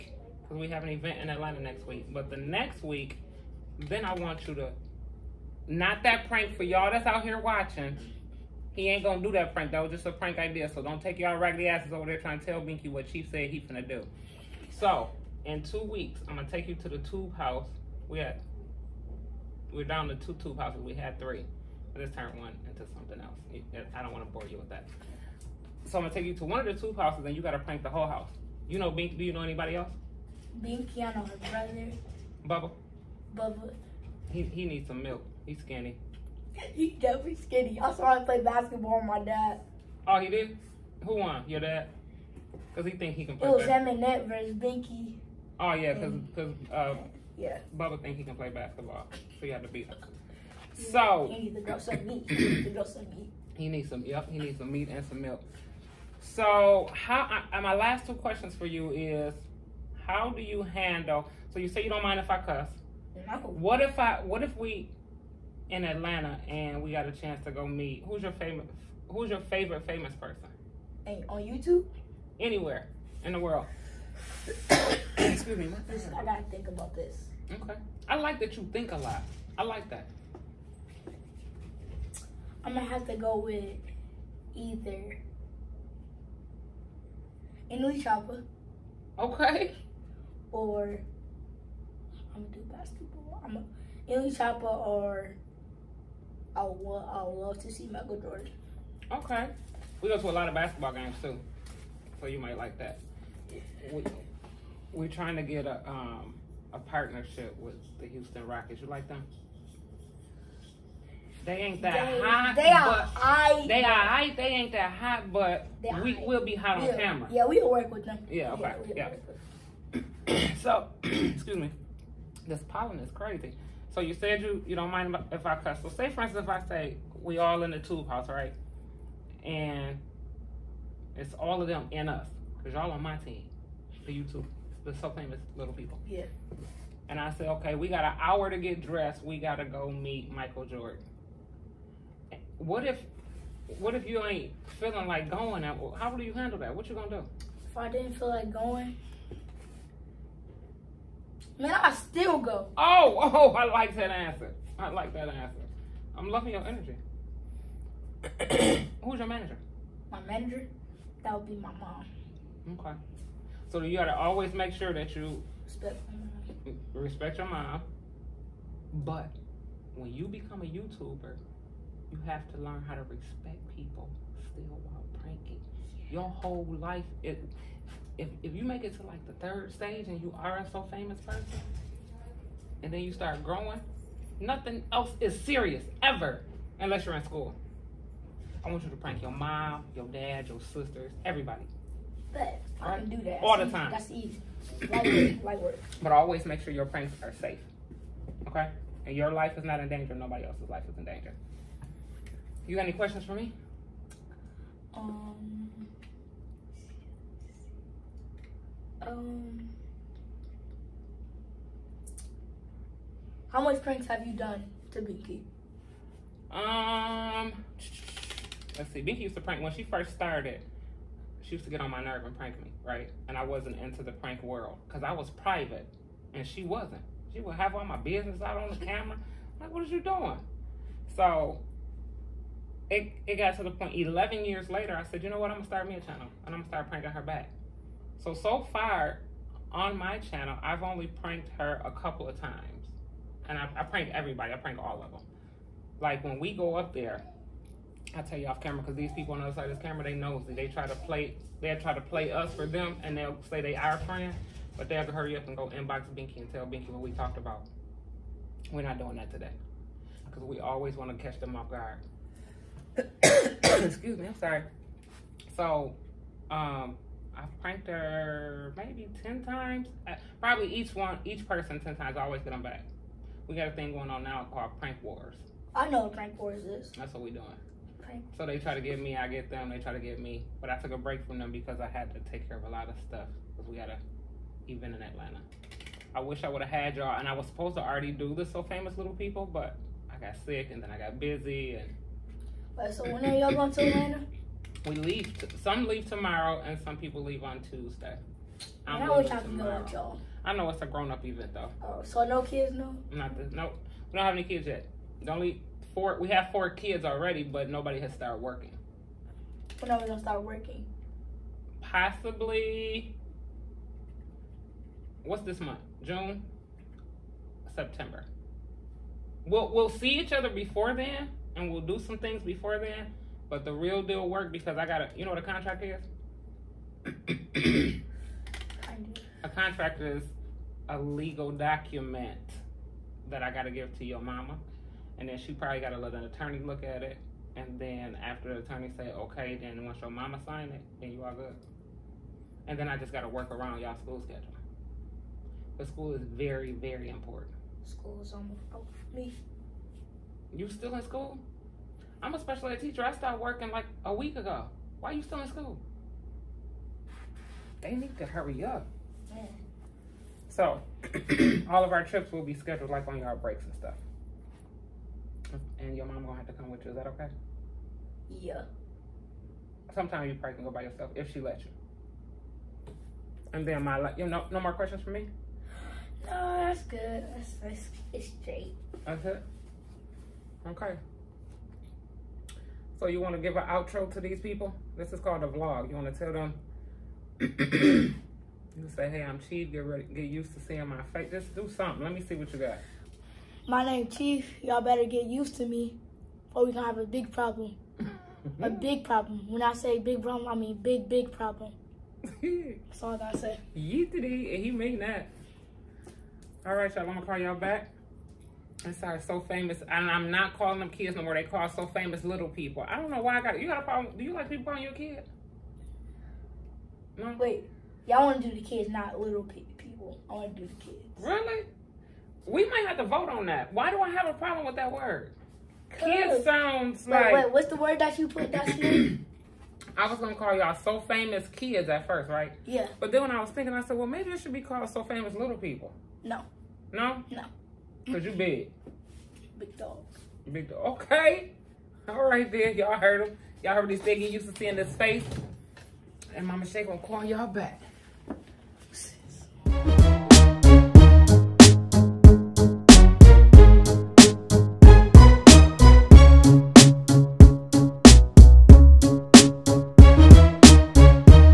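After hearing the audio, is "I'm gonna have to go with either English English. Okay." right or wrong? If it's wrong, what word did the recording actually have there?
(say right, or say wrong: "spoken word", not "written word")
wrong: "Chopper", not "English".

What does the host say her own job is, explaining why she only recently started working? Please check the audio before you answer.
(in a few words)
special ed teacher.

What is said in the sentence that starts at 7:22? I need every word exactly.
All right then, y'all heard him.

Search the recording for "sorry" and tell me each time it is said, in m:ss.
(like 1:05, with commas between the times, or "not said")
4:24, 6:48.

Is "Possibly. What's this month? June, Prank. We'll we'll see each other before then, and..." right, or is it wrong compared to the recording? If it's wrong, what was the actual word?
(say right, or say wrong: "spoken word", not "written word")
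wrong: "September", not "Prank".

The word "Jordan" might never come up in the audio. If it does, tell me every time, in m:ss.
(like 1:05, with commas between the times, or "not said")
1:38, 2:20.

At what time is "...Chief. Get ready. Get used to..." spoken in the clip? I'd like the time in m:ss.
6:29.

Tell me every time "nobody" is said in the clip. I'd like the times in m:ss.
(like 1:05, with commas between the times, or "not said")
3:20, 5:07.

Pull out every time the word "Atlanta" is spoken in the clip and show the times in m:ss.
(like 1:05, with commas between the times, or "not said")
0:01, 1:05, 4:45, 4:53.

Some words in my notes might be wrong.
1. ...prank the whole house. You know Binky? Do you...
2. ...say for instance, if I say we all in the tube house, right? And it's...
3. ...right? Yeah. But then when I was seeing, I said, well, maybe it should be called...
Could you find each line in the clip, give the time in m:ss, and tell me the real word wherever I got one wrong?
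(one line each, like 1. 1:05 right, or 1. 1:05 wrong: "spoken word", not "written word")
1. 0:27 right
2. 2:05 right
3. 7:12 wrong: "thinking", not "seeing".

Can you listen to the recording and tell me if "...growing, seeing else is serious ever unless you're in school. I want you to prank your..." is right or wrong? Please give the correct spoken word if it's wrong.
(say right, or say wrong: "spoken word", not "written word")
wrong: "nothing", not "seeing".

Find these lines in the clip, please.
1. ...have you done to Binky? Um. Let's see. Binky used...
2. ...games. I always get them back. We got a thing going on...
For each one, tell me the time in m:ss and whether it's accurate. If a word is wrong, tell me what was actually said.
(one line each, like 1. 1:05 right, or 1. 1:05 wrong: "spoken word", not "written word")
1. 3:34 right
2. 4:31 wrong: "times", not "games".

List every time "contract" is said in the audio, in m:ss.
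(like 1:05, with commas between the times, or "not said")
5:25, 5:29.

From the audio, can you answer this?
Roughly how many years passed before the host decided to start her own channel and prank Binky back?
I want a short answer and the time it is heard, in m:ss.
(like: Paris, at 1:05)
11, at 3:53.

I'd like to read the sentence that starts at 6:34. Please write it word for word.
Y'all better get used to me, or we gonna have a big problem.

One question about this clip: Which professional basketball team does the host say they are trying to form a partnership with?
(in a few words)
Houston Rockets.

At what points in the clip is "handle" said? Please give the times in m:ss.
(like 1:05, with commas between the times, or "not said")
1:00, 2:26.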